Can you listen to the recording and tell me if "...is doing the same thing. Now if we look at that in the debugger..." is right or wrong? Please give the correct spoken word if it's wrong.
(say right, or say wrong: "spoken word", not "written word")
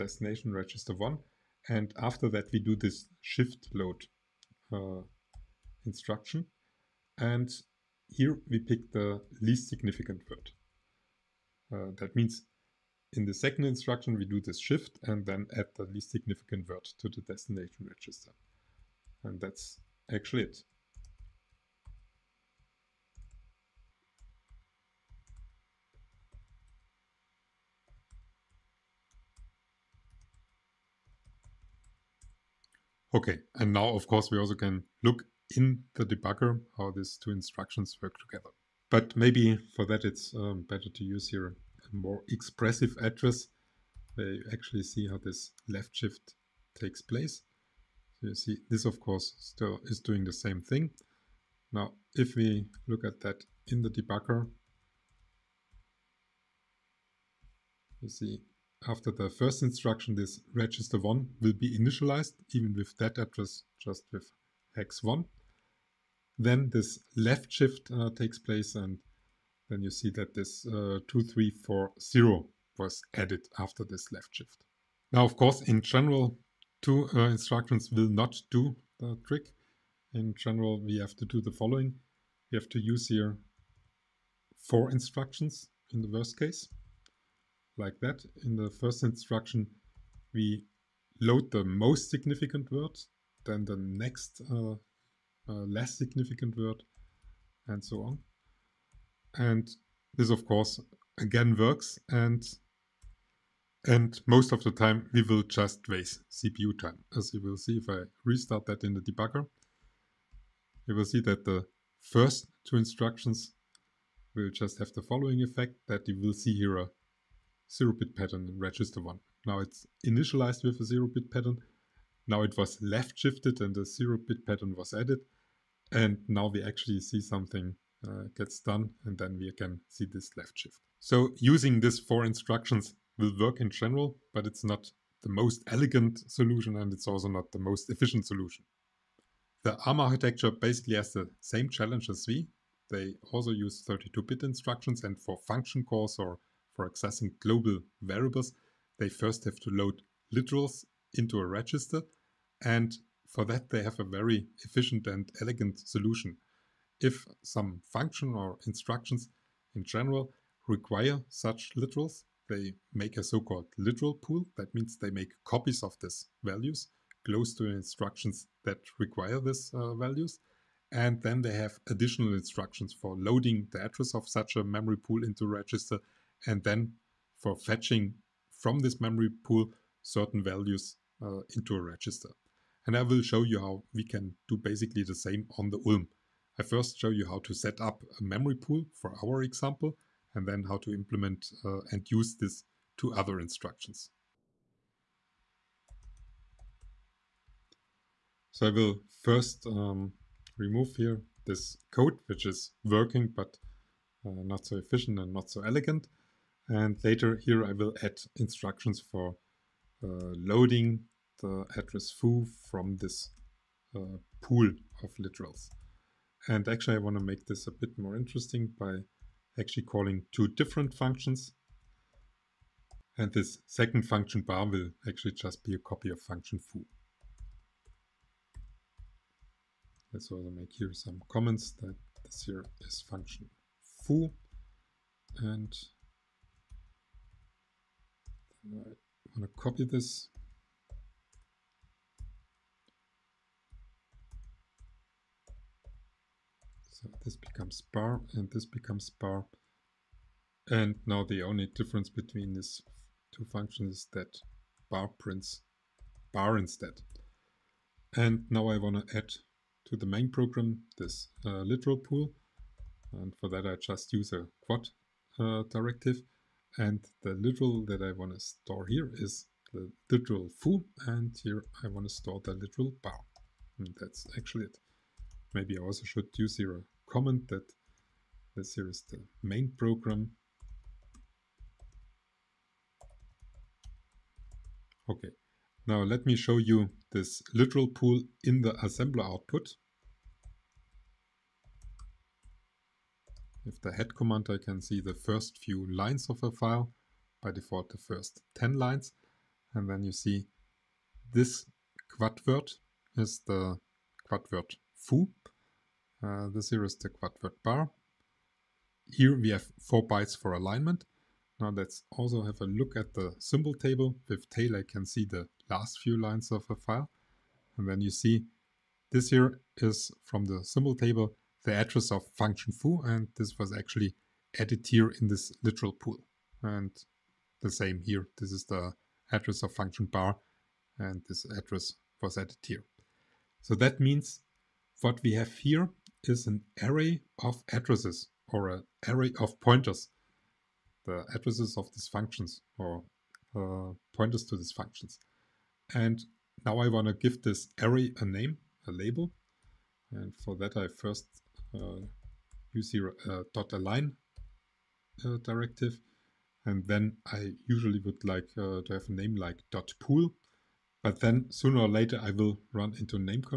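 right.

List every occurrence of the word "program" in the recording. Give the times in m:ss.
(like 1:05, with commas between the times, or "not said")
4:20, 4:39.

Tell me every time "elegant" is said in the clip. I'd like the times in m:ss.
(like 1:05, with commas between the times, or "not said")
2:15, 2:35, 3:25.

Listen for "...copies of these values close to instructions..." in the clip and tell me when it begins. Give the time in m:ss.
2:45.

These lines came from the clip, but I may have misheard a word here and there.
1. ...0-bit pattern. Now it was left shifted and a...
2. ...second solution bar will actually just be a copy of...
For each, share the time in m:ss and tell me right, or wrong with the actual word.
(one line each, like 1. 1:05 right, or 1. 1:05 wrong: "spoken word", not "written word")
1. 2:00 right
2. 3:43 wrong: "function", not "solution".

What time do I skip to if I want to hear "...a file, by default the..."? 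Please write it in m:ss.
4:56.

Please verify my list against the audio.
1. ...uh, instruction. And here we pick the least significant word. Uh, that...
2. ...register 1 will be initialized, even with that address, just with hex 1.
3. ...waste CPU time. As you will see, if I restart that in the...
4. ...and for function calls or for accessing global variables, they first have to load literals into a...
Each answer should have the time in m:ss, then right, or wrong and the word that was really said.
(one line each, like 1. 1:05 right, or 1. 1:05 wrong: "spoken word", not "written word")
1. 0:04 right
2. 1:00 right
3. 1:45 right
4. 2:25 right.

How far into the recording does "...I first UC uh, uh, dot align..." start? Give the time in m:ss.
5:50.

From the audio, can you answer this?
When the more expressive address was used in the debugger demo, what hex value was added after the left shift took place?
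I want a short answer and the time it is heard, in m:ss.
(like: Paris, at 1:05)
2340, at 1:11.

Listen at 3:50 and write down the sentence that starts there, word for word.
Let's also make here some comments that this here is function foo and i want to copy this.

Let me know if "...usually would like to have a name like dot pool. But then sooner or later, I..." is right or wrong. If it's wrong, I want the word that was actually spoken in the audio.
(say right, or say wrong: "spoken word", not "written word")
right.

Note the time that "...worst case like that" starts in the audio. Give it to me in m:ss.
1:26.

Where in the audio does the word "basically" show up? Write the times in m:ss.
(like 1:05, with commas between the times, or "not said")
2:20, 3:04.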